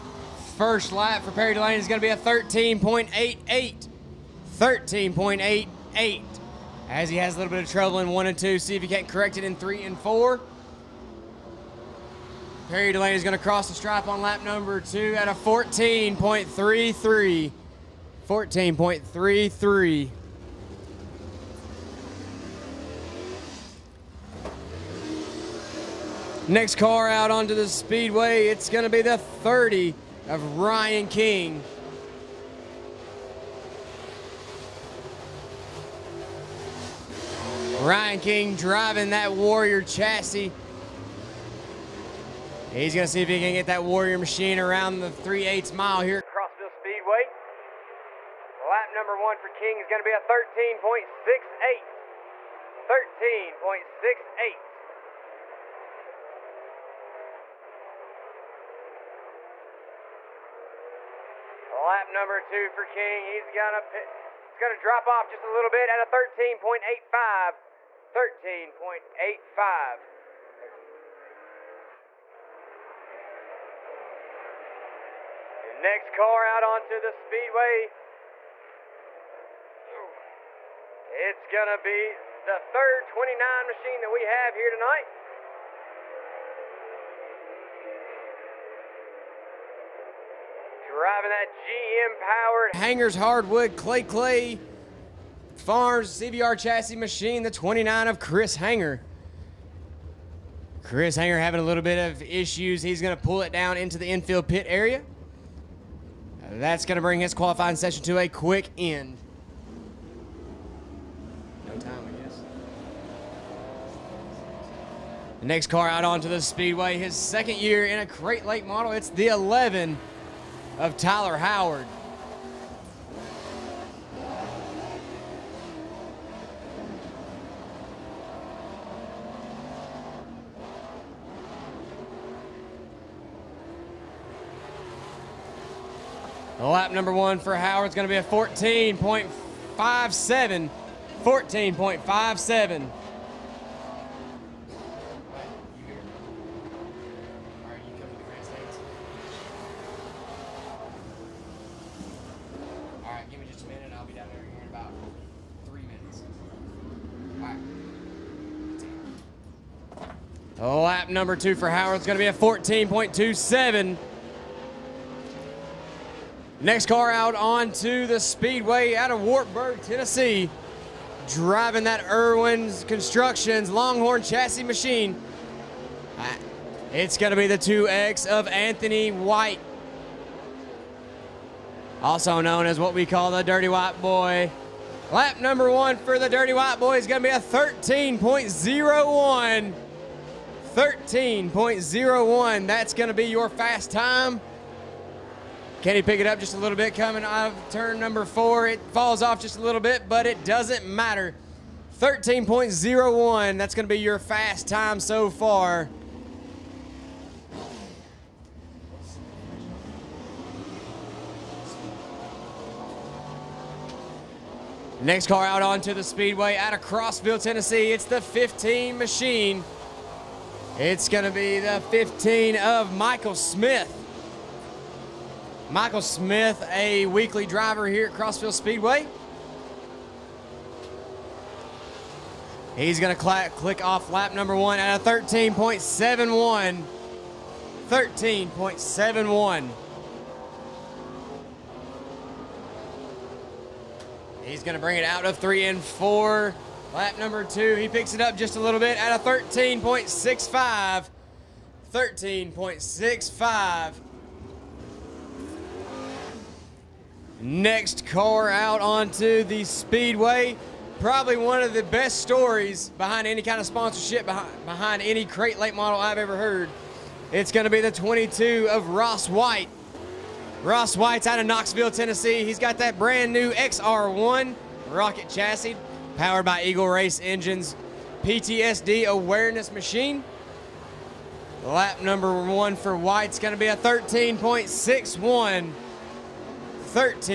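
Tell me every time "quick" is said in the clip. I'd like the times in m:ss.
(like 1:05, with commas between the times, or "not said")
1:48.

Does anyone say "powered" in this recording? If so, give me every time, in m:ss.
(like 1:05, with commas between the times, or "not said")
1:32, 4:36.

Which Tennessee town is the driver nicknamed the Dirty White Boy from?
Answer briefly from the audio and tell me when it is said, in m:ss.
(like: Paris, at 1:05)
Wartburg, at 2:49.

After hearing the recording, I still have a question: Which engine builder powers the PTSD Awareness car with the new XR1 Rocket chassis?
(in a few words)
Eagle Race Engines.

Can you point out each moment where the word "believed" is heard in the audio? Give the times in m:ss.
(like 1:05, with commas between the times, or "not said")
not said.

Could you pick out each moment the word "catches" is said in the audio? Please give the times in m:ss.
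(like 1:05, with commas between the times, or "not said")
not said.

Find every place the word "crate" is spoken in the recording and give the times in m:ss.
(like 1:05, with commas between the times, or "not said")
1:58, 4:25.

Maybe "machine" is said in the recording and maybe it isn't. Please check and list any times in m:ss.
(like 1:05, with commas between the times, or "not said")
0:44, 1:23, 1:36, 2:54, 3:38, 4:39.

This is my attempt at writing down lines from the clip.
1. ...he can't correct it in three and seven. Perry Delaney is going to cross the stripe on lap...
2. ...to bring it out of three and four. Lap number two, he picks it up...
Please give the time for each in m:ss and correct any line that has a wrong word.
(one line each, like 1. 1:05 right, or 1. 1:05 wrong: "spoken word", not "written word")
1. 0:08 wrong: "four", not "seven"
2. 4:04 right.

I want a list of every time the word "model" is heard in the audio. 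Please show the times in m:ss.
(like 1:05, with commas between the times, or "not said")
1:58, 4:25.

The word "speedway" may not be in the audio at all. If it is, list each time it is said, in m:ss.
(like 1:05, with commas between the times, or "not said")
0:27, 0:46, 1:17, 1:56, 2:48, 3:36, 3:48, 4:19.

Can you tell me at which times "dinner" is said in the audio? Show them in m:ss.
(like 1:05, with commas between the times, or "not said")
not said.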